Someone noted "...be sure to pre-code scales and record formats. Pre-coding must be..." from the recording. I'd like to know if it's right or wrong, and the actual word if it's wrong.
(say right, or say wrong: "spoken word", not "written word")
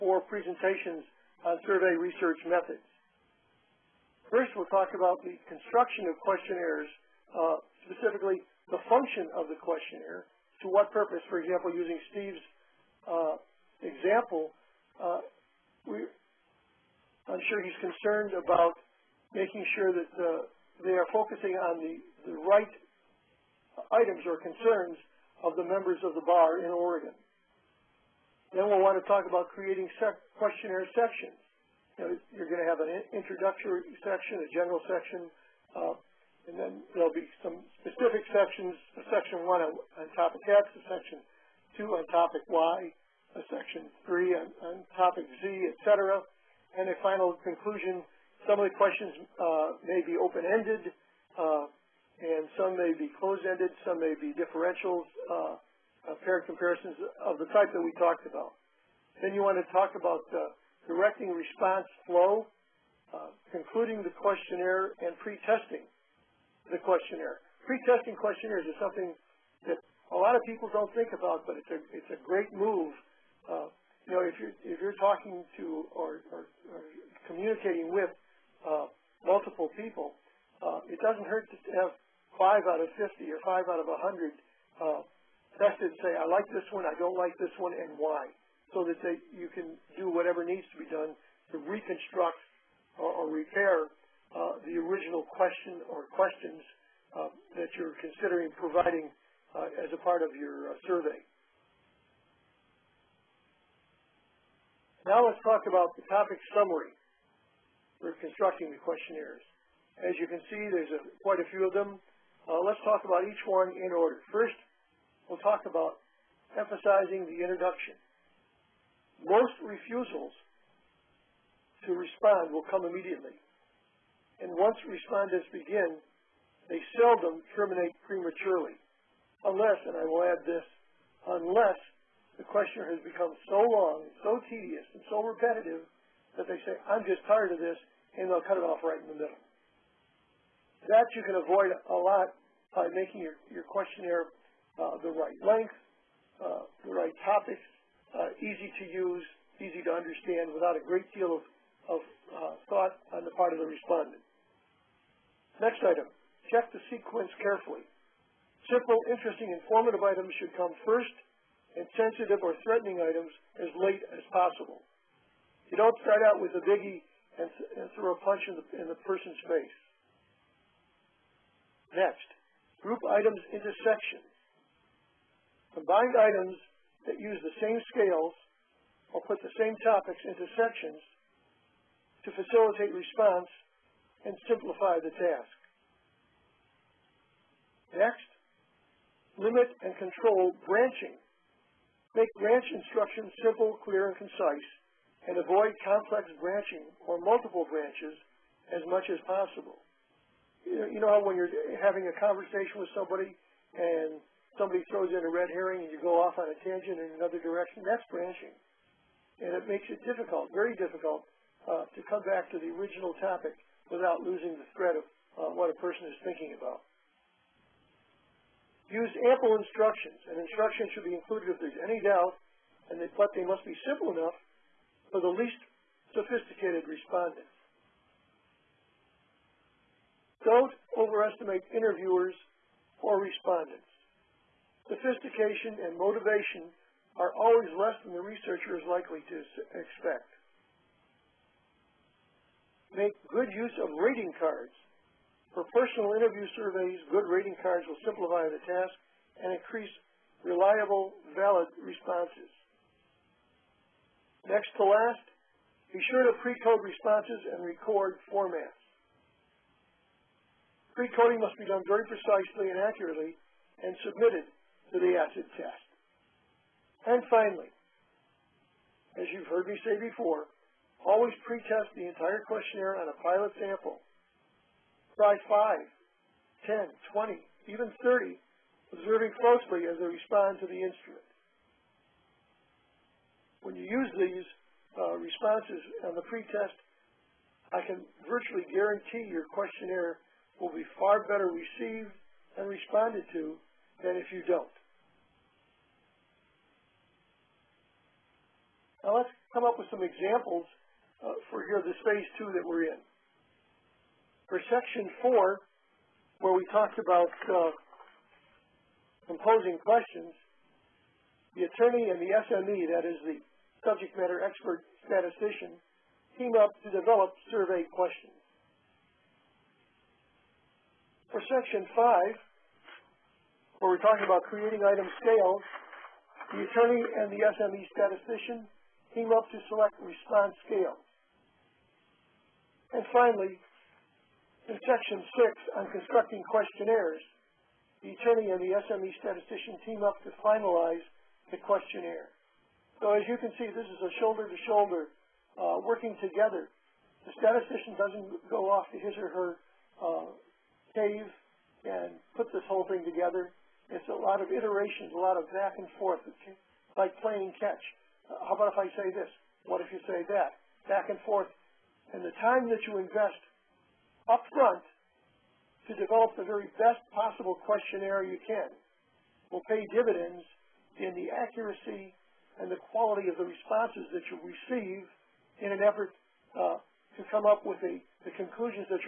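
wrong: "responses", not "scales".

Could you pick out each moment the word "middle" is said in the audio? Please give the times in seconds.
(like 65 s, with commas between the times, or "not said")
139 s.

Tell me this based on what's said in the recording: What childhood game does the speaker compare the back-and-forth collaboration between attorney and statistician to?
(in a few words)
Catch.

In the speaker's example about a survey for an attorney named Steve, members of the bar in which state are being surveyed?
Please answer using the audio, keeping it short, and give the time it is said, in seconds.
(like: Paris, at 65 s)
Oregon, at 26 s.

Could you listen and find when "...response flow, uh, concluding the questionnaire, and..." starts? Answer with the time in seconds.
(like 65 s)
61 s.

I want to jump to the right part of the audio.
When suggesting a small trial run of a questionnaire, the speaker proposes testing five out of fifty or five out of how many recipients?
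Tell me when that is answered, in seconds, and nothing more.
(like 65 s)
83 s.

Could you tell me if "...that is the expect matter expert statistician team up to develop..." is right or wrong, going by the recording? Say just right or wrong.
wrong.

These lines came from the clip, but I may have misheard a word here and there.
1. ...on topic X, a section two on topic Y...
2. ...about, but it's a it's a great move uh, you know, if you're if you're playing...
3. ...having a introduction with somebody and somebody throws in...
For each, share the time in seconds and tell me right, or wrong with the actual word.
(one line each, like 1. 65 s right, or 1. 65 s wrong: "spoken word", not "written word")
1. 39 s right
2. 71 s wrong: "talking", not "playing"
3. 201 s wrong: "conversation", not "introduction".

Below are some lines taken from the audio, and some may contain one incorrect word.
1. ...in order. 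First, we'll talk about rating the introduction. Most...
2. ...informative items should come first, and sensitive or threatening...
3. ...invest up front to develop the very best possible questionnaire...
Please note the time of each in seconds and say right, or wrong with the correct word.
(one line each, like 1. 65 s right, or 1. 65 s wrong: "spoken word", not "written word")
1. 113 s wrong: "emphasizing", not "rating"
2. 159 s right
3. 363 s right.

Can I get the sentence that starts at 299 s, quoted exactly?
Now let's come up with some examples uh, for here, this phase two that we're in.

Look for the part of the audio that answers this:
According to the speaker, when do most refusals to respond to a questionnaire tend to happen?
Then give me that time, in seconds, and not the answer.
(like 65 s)
122 s.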